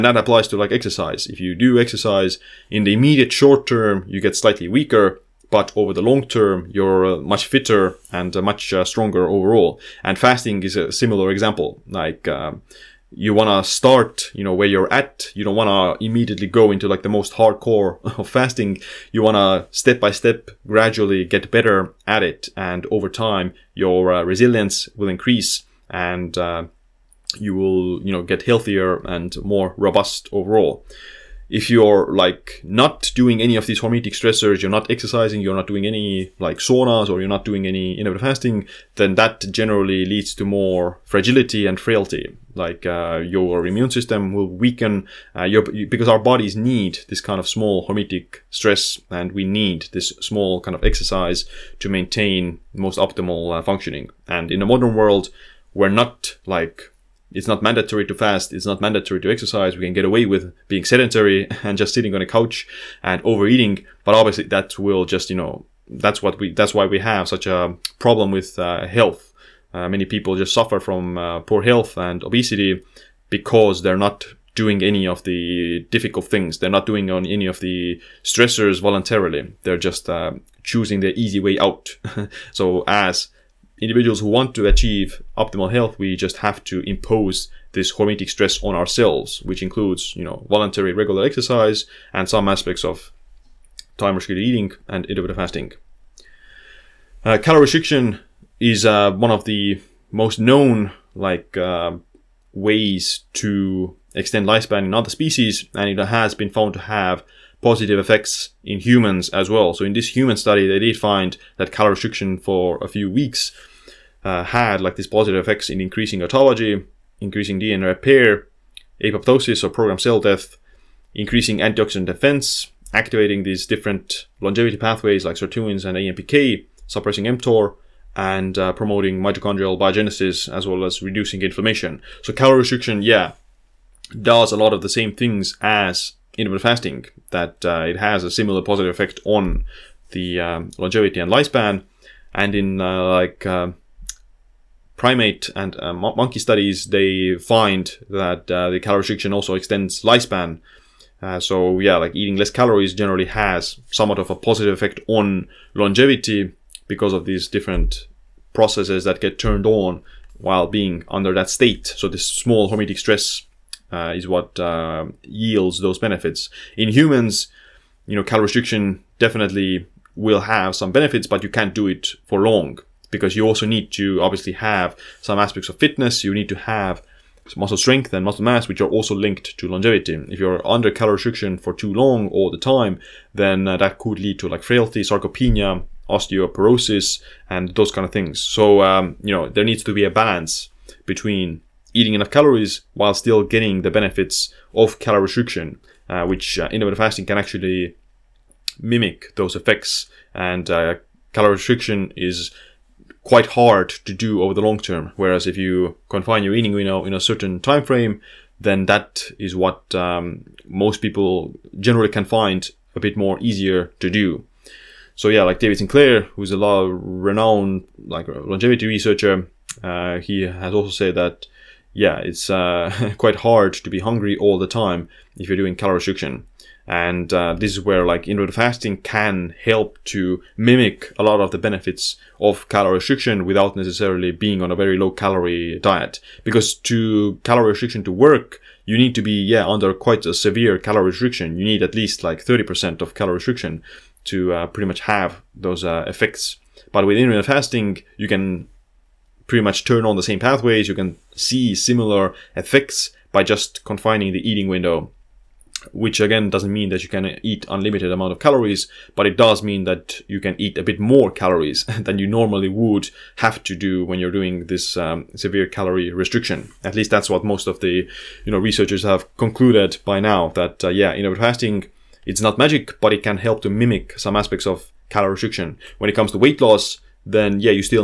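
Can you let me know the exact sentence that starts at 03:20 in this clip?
And uh, calorie restriction is quite hard to do over the long term.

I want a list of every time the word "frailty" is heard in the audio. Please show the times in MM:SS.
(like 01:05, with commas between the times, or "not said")
00:41, 03:04.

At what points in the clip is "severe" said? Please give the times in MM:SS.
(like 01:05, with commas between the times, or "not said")
04:00, 04:25.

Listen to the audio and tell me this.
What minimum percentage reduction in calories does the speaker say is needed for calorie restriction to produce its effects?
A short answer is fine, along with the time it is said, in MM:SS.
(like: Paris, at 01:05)
30%, at 04:02.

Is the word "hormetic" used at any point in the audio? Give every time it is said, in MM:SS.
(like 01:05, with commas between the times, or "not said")
00:33, 00:47, 01:27, 02:42.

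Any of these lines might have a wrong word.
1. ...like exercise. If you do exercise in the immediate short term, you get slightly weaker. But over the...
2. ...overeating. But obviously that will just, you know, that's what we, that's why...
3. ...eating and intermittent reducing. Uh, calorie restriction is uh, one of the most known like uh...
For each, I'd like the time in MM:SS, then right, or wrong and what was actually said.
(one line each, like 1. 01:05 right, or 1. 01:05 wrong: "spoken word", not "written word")
1. 00:00 right
2. 01:03 right
3. 01:34 wrong: "fasting", not "reducing".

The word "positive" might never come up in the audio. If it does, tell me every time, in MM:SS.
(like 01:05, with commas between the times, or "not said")
01:47, 01:55, 02:18, 02:34.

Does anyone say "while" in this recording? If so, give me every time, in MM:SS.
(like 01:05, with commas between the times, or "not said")
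02:40, 03:12.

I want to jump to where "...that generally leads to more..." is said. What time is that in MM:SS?
00:39.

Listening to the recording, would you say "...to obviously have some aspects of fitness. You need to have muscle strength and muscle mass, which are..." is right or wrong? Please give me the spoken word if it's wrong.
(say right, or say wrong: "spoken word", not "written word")
right.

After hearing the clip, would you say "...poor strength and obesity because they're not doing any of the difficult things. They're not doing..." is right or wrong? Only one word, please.
wrong.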